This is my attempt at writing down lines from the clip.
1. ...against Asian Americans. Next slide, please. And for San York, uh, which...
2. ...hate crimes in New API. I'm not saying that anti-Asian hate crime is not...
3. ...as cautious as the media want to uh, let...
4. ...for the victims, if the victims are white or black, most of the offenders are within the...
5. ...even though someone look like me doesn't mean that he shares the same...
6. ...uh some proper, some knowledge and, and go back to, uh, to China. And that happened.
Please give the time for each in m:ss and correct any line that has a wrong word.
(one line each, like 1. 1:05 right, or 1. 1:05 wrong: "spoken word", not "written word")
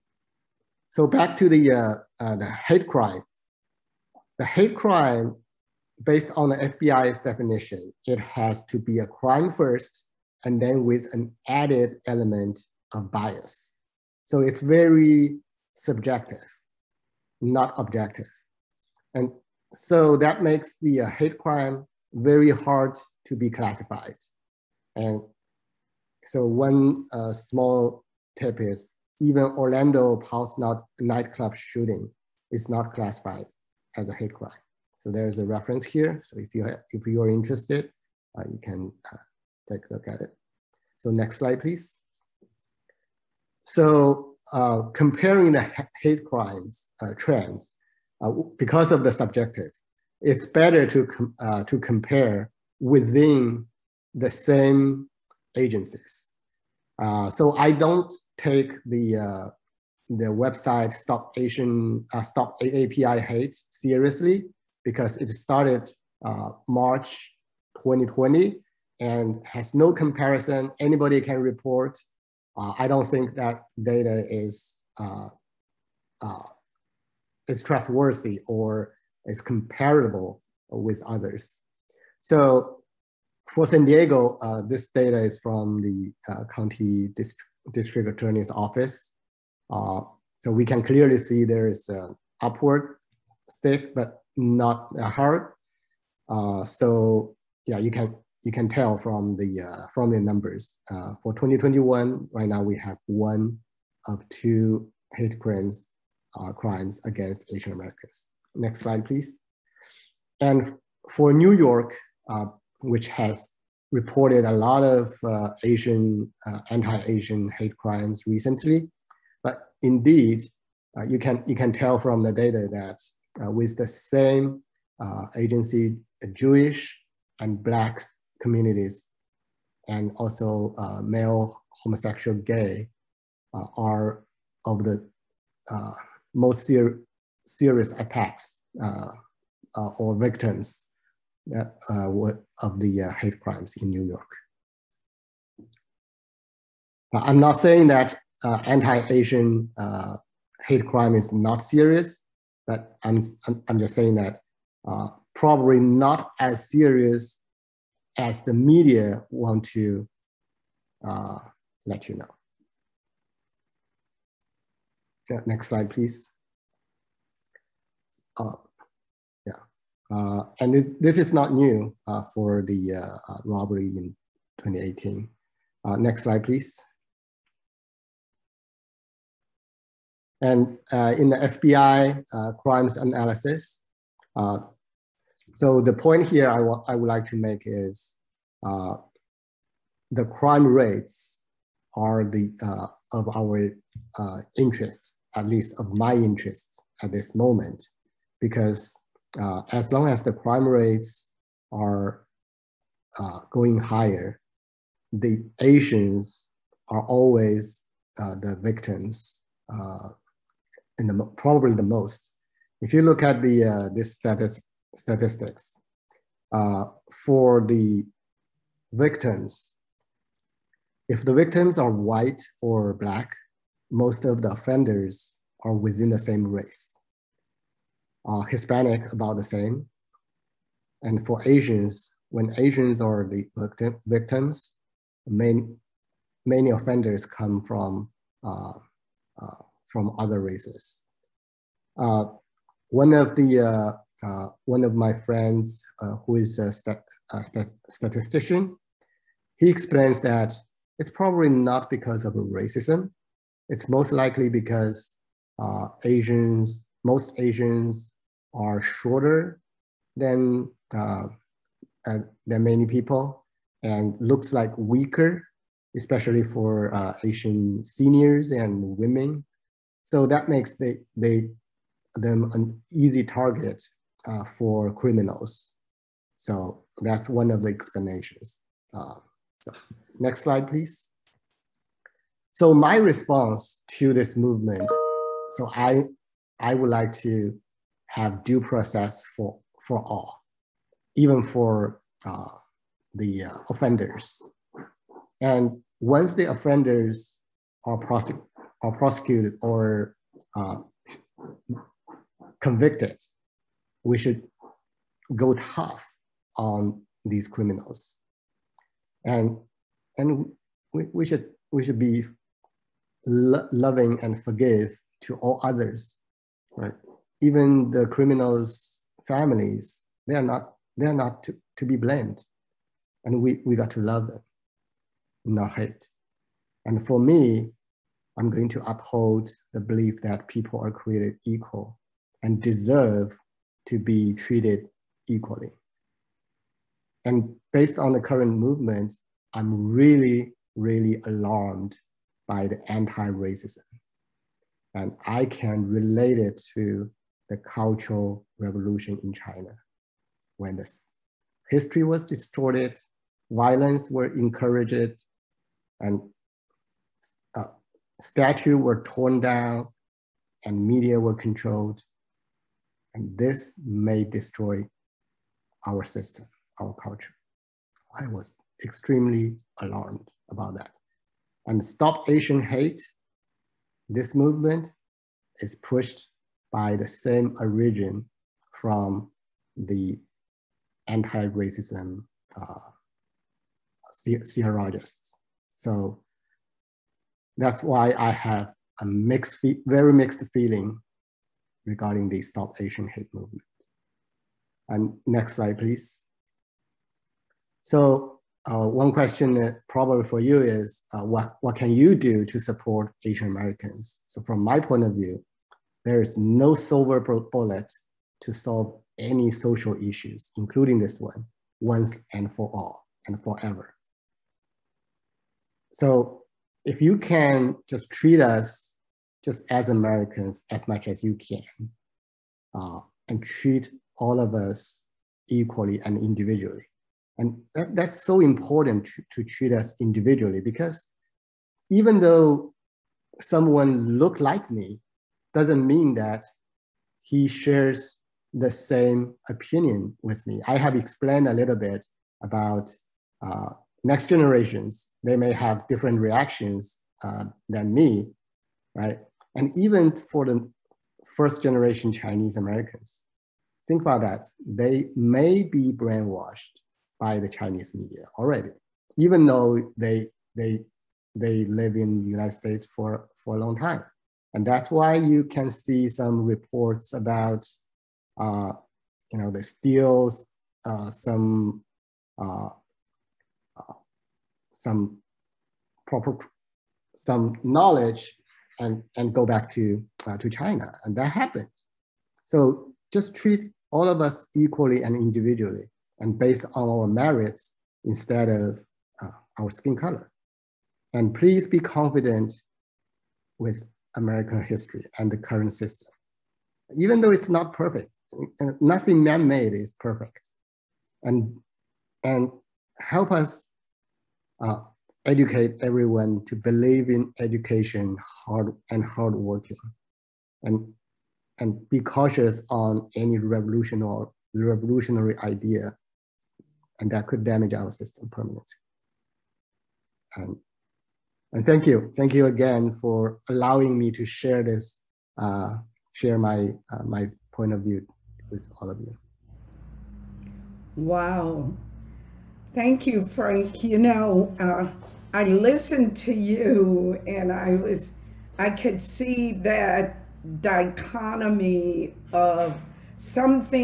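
1. 1:47 wrong: "New", not "San"
2. 2:23 wrong: "York", not "API"
3. 2:36 wrong: "serious", not "cautious"
4. 3:37 right
5. 7:11 right
6. 7:53 right.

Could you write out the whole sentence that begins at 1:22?
So for San Diego, uh, this data is from the uh, county dist district attorney's office.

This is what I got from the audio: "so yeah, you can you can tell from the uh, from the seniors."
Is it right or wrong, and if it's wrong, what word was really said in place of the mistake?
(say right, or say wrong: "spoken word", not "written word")
wrong: "numbers", not "seniors".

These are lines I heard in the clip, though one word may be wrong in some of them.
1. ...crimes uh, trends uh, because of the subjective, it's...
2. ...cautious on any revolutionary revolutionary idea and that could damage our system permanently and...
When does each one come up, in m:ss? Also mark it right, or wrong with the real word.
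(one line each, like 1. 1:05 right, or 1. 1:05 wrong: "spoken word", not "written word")
1. 0:46 right
2. 8:31 right.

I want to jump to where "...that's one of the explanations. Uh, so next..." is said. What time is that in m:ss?
4:37.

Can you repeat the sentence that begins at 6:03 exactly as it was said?
And this may destroy our system, our culture.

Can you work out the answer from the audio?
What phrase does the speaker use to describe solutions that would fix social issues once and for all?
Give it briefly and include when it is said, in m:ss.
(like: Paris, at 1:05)
No silver bullet, at 6:46.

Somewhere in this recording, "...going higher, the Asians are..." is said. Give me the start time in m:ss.
3:23.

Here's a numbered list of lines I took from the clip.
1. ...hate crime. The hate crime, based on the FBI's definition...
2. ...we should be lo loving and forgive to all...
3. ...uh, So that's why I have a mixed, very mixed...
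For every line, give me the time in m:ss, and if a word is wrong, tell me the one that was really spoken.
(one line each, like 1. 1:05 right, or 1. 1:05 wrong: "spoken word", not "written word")
1. 0:02 right
2. 5:11 right
3. 6:22 right.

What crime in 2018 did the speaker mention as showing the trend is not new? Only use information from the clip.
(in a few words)
Robbery.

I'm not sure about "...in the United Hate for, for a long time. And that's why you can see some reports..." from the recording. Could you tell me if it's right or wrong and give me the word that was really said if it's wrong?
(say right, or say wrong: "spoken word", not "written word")
wrong: "States", not "Hate".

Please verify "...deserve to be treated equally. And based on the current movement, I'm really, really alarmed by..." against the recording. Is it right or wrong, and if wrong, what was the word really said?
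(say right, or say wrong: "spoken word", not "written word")
right.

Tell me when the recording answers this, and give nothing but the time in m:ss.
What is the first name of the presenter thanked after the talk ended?
8:53.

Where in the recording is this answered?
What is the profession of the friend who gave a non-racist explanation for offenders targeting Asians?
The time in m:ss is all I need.
4:07.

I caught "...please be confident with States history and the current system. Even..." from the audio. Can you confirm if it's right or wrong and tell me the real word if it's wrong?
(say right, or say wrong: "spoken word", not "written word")
wrong: "American", not "States".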